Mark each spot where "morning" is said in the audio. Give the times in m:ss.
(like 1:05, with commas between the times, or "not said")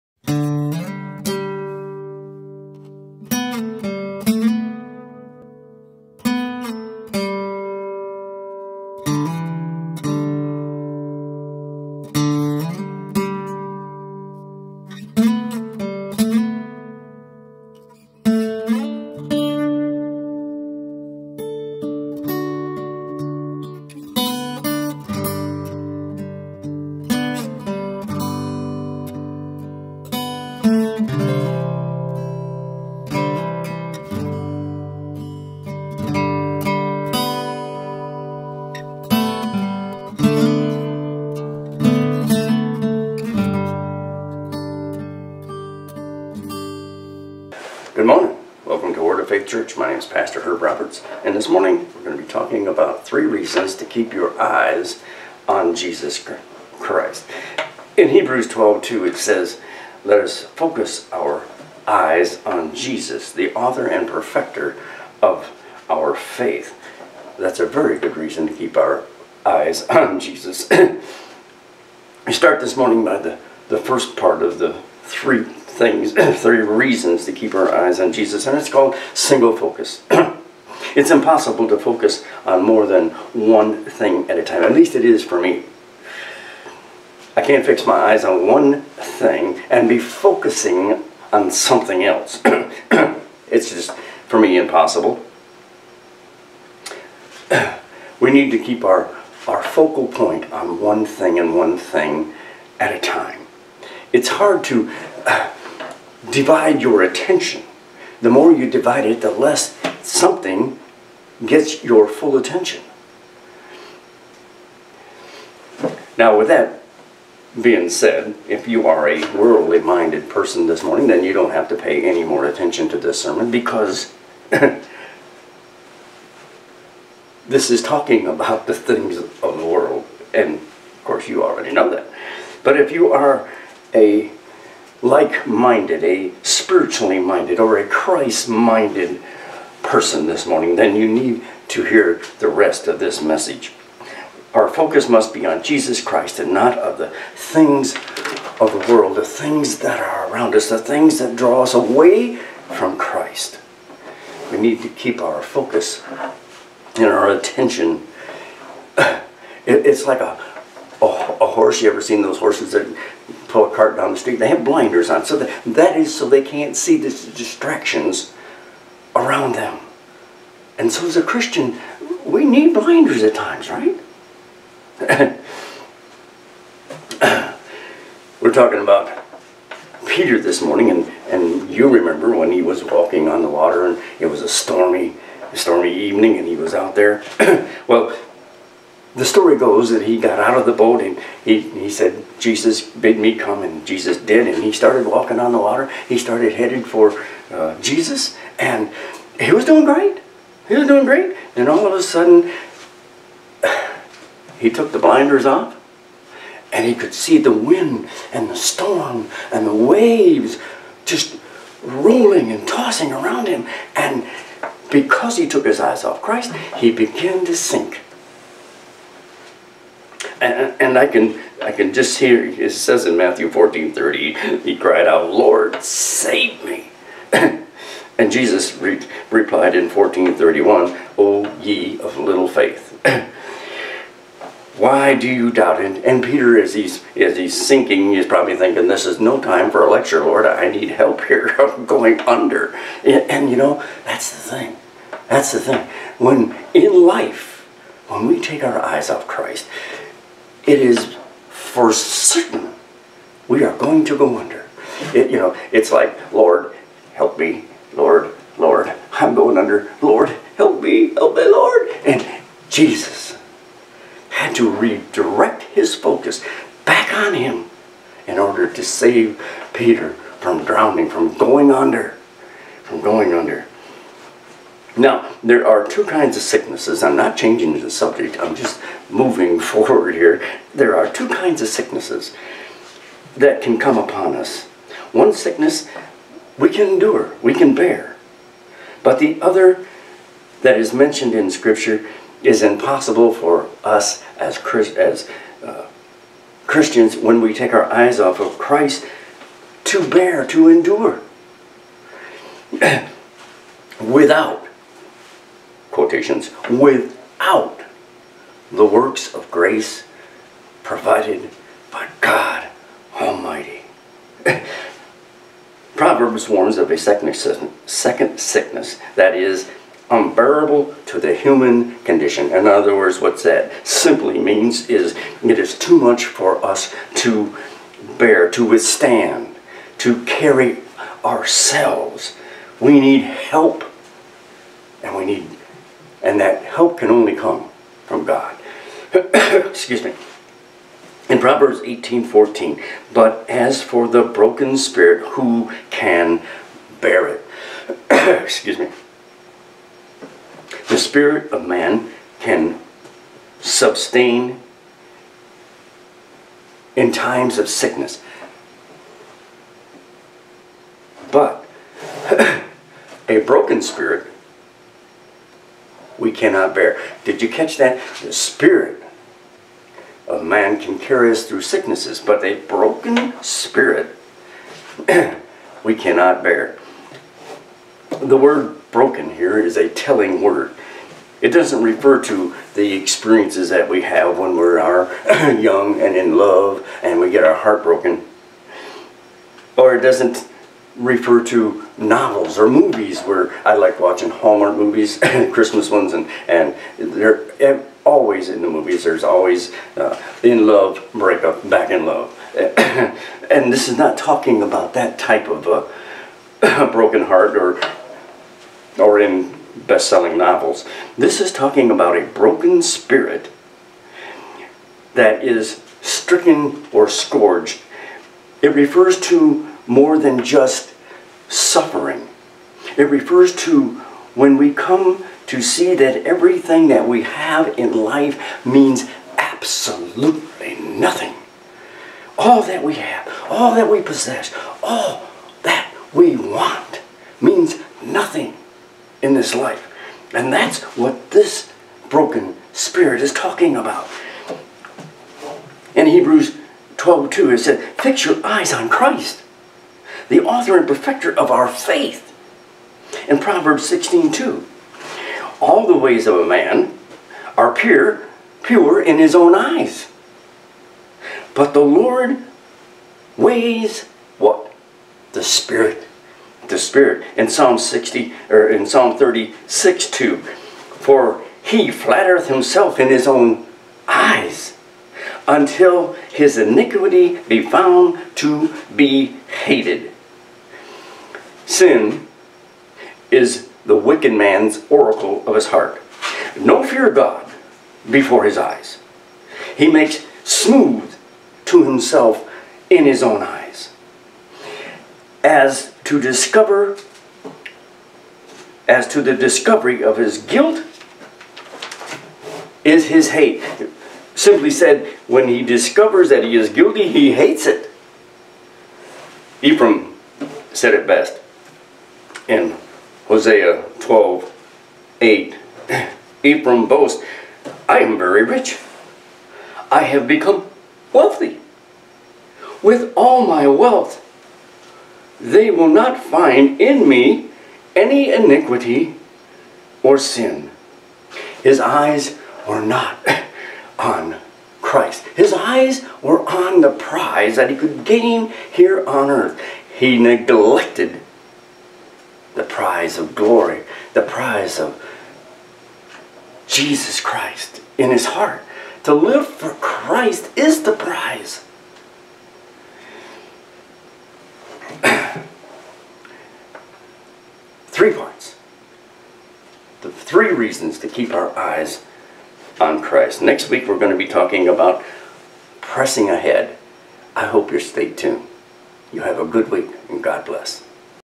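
0:51, 1:12, 2:00, 2:20, 3:00.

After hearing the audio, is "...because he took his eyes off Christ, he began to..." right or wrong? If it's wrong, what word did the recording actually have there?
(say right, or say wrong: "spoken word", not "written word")
right.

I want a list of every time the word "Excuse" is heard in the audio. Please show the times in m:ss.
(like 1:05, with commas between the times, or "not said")
5:39, 5:48.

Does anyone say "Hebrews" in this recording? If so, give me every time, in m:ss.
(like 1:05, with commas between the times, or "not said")
0:58, 7:26.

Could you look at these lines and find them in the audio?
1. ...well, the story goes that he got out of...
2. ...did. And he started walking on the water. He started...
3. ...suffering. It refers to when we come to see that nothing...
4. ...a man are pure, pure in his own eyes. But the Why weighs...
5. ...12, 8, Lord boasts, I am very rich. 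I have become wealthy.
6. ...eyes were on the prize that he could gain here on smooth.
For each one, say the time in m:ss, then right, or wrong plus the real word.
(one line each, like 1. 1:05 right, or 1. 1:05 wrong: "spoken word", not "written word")
1. 3:07 right
2. 3:14 right
3. 7:01 wrong: "everything", not "nothing"
4. 7:36 wrong: "Lord", not "Why"
5. 8:34 wrong: "Ephraim", not "Lord"
6. 8:55 wrong: "earth", not "smooth".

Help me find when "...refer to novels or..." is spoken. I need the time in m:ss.
6:30.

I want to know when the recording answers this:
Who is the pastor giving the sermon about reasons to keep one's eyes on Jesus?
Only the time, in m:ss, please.
0:50.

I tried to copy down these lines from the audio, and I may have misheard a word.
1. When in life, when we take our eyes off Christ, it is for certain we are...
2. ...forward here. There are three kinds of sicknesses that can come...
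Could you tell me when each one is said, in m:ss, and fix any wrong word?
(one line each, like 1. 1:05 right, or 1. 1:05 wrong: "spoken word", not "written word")
1. 4:06 right
2. 4:39 wrong: "two", not "three".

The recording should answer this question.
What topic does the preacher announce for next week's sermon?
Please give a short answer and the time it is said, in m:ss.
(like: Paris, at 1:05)
Pressing ahead, at 9:25.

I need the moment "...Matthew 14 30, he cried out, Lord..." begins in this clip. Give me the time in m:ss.
3:43.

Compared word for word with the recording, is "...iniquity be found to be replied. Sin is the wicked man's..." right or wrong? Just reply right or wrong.
wrong.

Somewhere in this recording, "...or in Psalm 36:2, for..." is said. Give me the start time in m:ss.
7:48.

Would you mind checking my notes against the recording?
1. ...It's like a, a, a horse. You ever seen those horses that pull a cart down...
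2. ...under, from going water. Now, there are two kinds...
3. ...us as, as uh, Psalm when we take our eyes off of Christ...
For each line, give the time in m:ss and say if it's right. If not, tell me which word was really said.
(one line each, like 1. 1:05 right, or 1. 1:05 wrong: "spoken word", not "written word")
1. 2:39 right
2. 4:31 wrong: "under", not "water"
3. 4:53 wrong: "Christians", not "Psalm".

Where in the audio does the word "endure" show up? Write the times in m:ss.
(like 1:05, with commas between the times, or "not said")
4:46, 5:00.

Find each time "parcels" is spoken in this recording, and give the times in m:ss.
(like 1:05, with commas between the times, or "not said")
not said.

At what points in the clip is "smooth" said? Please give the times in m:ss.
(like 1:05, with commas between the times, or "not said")
8:10.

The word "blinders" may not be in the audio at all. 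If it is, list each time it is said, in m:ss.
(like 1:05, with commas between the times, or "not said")
2:44, 2:52, 3:24.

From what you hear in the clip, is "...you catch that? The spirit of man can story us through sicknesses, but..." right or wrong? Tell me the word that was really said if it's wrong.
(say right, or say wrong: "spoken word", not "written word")
wrong: "carry", not "story".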